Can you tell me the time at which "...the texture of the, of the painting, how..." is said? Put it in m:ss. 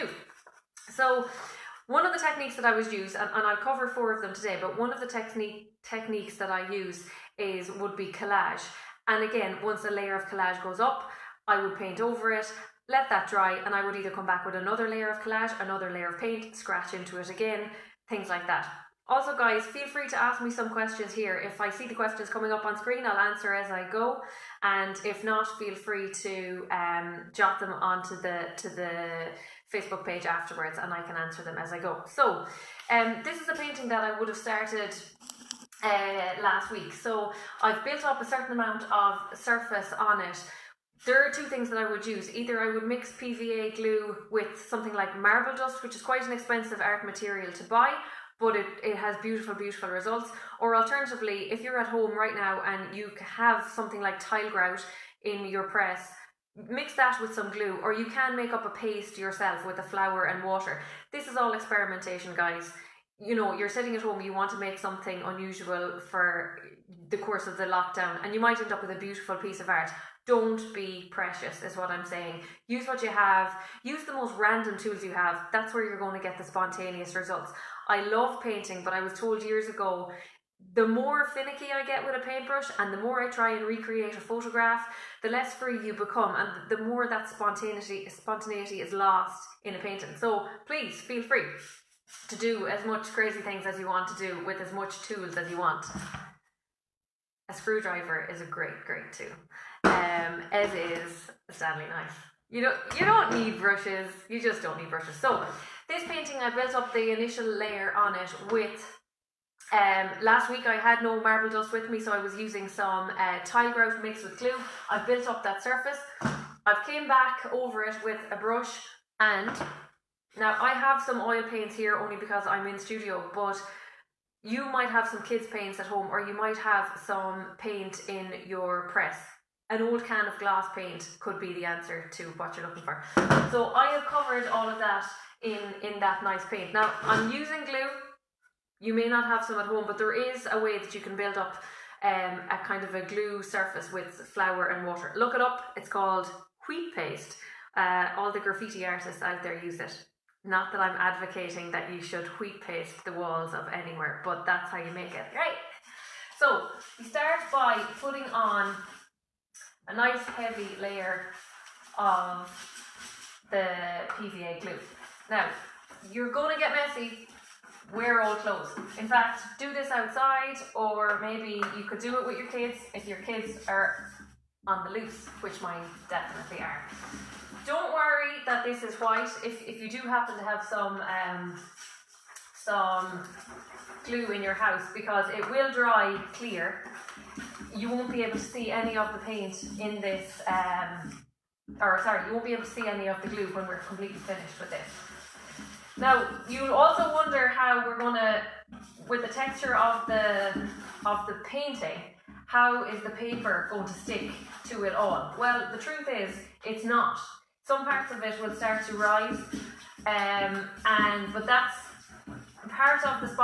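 3:19.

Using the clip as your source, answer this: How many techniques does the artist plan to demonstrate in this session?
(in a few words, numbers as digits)
4.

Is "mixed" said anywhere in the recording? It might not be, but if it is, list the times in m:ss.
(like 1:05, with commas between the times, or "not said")
1:54.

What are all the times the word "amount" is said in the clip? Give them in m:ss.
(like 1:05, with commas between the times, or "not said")
0:38.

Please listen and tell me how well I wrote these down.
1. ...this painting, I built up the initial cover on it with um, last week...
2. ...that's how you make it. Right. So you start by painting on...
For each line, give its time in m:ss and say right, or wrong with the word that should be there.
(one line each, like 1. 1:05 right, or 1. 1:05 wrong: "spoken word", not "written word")
1. 1:45 wrong: "layer", not "cover"
2. 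2:34 wrong: "putting", not "painting".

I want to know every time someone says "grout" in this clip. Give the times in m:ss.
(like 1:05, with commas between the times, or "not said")
0:54, 1:53.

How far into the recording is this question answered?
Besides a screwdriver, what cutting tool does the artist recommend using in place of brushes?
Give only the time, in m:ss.
1:41.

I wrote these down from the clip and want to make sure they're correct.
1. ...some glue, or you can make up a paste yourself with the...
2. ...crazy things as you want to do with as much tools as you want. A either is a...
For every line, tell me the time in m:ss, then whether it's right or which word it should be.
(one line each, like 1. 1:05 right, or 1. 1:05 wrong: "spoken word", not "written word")
1. 0:57 right
2. 1:33 wrong: "screwdriver", not "either".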